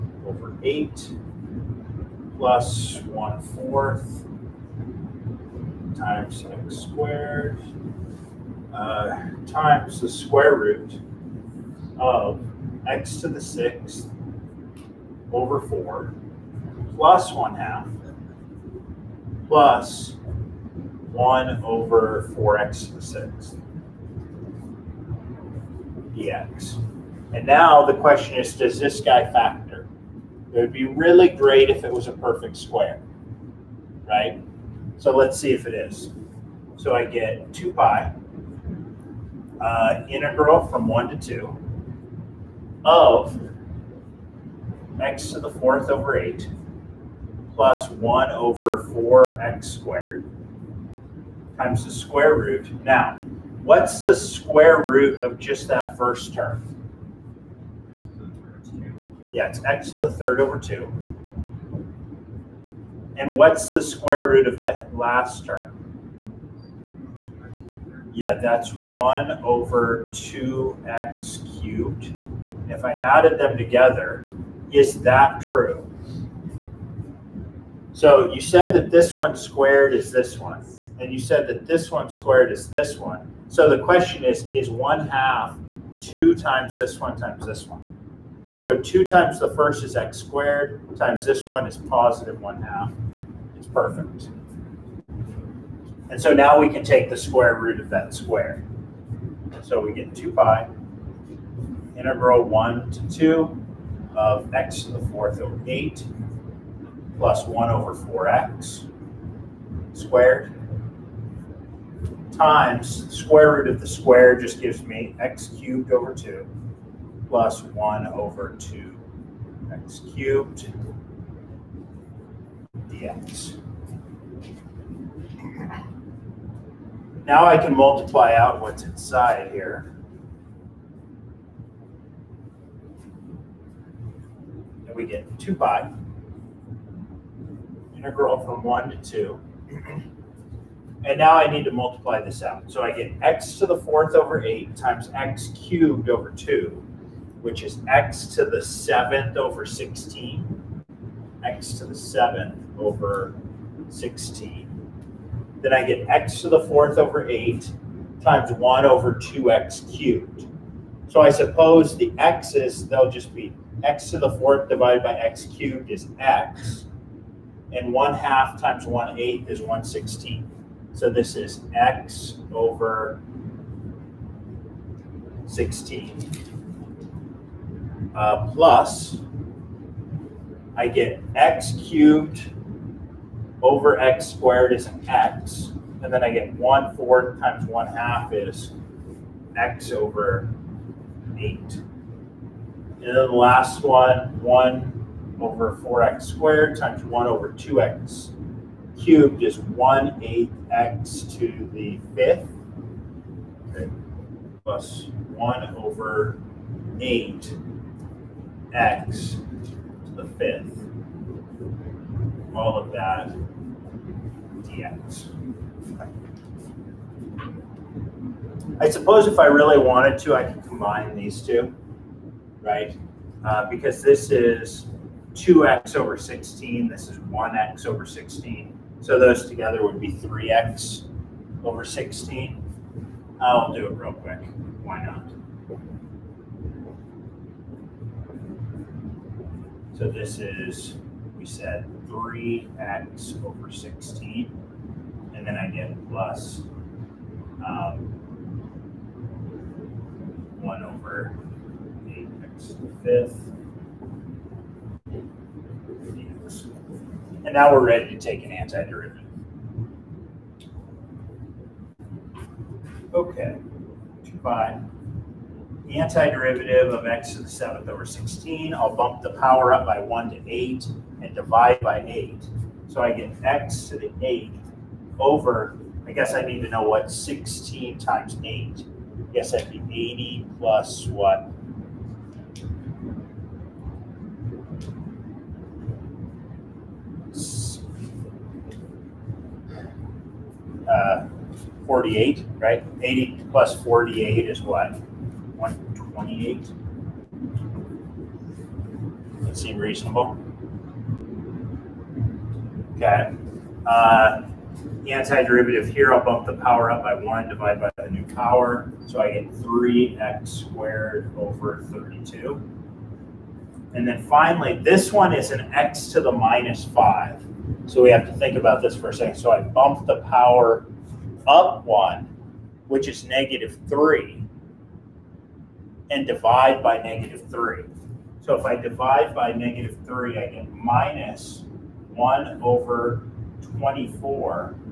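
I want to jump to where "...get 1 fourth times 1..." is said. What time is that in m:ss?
3:06.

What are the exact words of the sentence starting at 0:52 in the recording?
Now, What's the square root of just that first term?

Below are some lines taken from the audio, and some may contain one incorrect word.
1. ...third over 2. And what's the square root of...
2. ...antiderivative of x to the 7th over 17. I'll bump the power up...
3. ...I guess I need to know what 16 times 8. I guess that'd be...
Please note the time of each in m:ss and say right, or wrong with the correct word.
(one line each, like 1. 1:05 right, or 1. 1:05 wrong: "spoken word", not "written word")
1. 1:00 right
2. 4:25 wrong: "16", not "17"
3. 4:36 right.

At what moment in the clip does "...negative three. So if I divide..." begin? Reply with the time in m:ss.
5:27.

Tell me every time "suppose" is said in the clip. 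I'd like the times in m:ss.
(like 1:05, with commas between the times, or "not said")
2:41, 3:38.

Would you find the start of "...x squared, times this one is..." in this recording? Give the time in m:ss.
1:29.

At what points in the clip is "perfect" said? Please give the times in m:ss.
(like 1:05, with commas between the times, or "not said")
0:32, 1:33.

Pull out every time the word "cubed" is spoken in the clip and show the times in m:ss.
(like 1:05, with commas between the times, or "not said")
1:11, 1:55, 2:00, 2:25, 2:39, 2:45, 3:01, 3:18.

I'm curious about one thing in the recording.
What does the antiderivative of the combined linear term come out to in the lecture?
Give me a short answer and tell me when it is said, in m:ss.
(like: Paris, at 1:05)
3x^2/32, at 5:09.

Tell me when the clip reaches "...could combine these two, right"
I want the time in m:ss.
3:40.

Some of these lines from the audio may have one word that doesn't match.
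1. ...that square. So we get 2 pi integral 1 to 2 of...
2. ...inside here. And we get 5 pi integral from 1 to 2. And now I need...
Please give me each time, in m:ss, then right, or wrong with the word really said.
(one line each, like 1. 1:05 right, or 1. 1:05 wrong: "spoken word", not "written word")
1. 1:37 right
2. 2:08 wrong: "2", not "5".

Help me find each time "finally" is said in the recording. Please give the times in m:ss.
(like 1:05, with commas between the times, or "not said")
5:14.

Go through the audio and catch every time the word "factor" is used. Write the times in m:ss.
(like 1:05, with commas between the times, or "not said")
0:29.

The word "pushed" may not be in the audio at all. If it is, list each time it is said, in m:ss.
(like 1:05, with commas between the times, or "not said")
not said.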